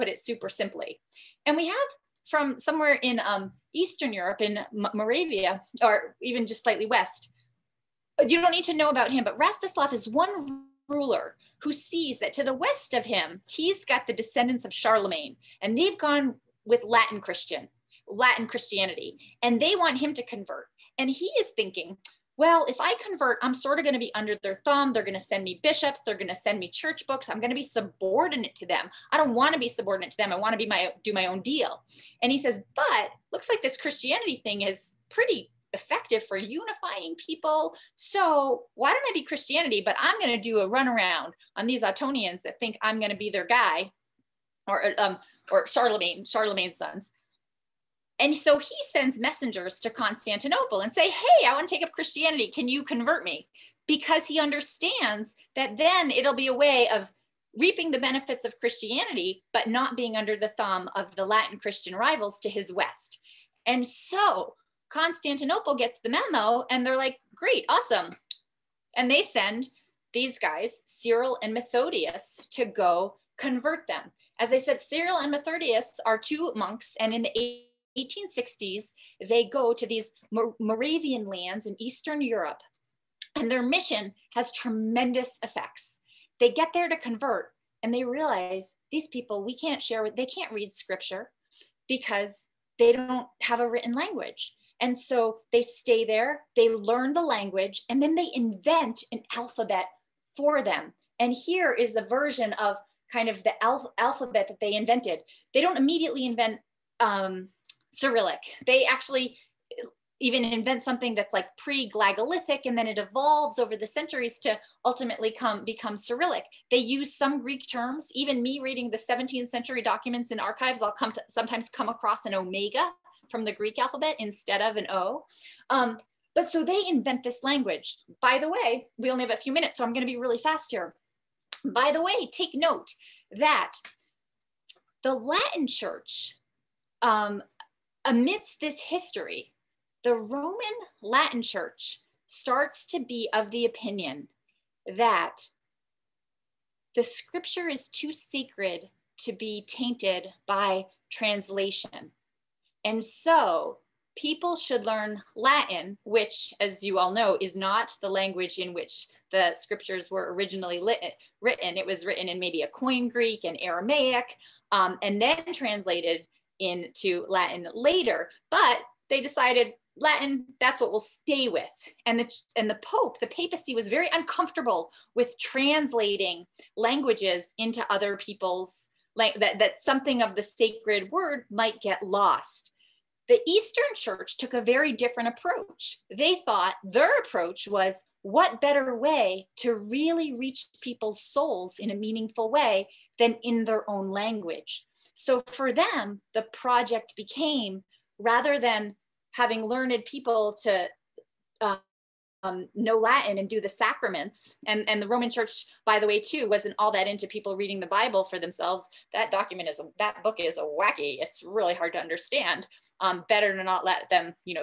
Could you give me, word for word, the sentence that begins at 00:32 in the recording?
And he says, but looks like this Christianity thing is pretty effective for unifying people.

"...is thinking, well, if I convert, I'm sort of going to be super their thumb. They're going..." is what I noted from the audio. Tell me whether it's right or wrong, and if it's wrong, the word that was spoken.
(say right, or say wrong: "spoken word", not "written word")
wrong: "under", not "super".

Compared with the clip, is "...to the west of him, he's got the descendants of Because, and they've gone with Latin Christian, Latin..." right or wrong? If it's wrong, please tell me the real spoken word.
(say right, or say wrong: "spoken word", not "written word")
wrong: "Charlemagne", not "Because".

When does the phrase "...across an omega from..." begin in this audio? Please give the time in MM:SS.
02:01.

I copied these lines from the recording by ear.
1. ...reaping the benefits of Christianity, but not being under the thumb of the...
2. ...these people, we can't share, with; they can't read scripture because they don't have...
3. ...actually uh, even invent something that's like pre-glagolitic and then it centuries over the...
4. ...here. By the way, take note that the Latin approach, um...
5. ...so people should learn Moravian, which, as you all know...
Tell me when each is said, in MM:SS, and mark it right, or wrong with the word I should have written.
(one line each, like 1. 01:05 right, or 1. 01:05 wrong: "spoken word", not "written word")
1. 00:57 right
2. 01:28 right
3. 01:48 wrong: "evolves", not "centuries"
4. 02:10 wrong: "church", not "approach"
5. 02:33 wrong: "Latin", not "Moravian".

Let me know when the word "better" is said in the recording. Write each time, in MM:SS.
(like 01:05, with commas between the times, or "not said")
03:08, 03:33.